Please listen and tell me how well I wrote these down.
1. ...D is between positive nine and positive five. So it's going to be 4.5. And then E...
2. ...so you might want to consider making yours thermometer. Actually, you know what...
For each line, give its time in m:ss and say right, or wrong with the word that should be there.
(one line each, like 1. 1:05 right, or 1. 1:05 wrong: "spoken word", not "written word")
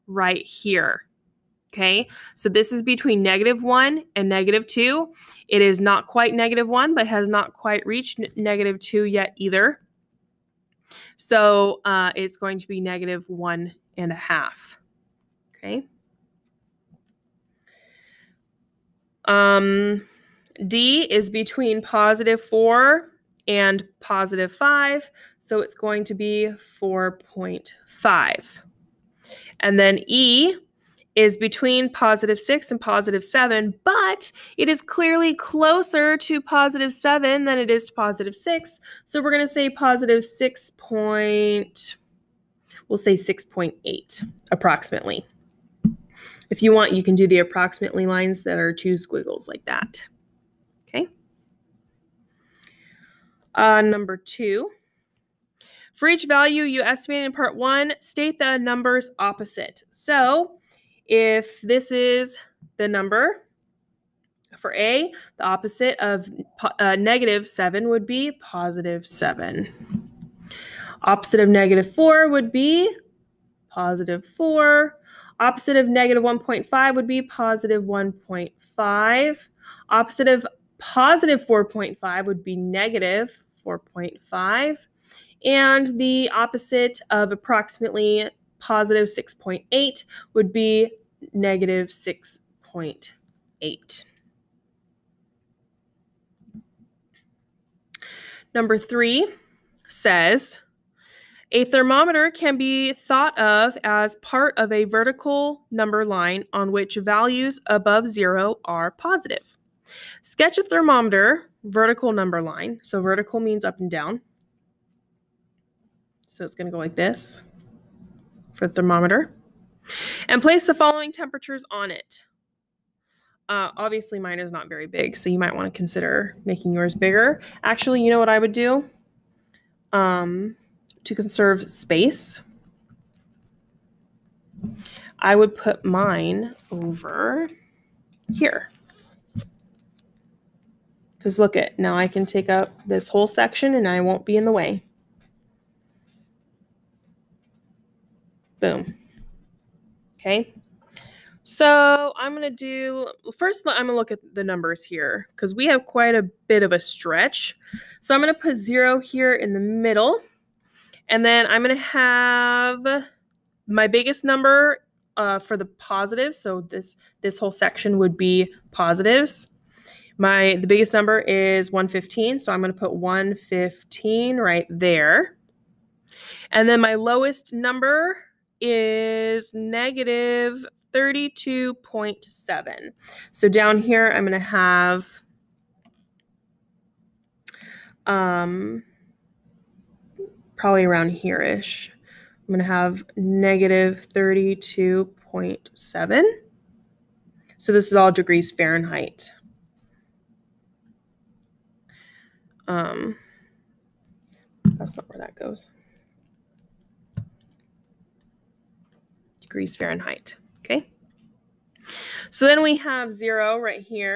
1. 0:20 wrong: "four", not "nine"
2. 2:05 wrong: "bigger", not "thermometer".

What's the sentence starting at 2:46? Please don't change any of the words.
So this this whole section would be positives.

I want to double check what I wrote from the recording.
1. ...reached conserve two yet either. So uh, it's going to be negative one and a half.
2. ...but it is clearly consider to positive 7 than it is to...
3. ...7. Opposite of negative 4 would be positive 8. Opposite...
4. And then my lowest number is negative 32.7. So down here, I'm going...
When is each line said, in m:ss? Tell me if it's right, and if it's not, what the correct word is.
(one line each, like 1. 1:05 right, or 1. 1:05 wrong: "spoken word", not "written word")
1. 0:07 wrong: "negative", not "conserve"
2. 0:33 wrong: "closer", not "consider"
3. 1:09 wrong: "4", not "8"
4. 2:56 right.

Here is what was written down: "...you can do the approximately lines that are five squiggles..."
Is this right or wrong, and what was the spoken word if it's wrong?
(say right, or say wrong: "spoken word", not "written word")
wrong: "two", not "five".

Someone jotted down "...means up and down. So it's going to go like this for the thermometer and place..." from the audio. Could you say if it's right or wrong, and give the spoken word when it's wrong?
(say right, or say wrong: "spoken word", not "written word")
right.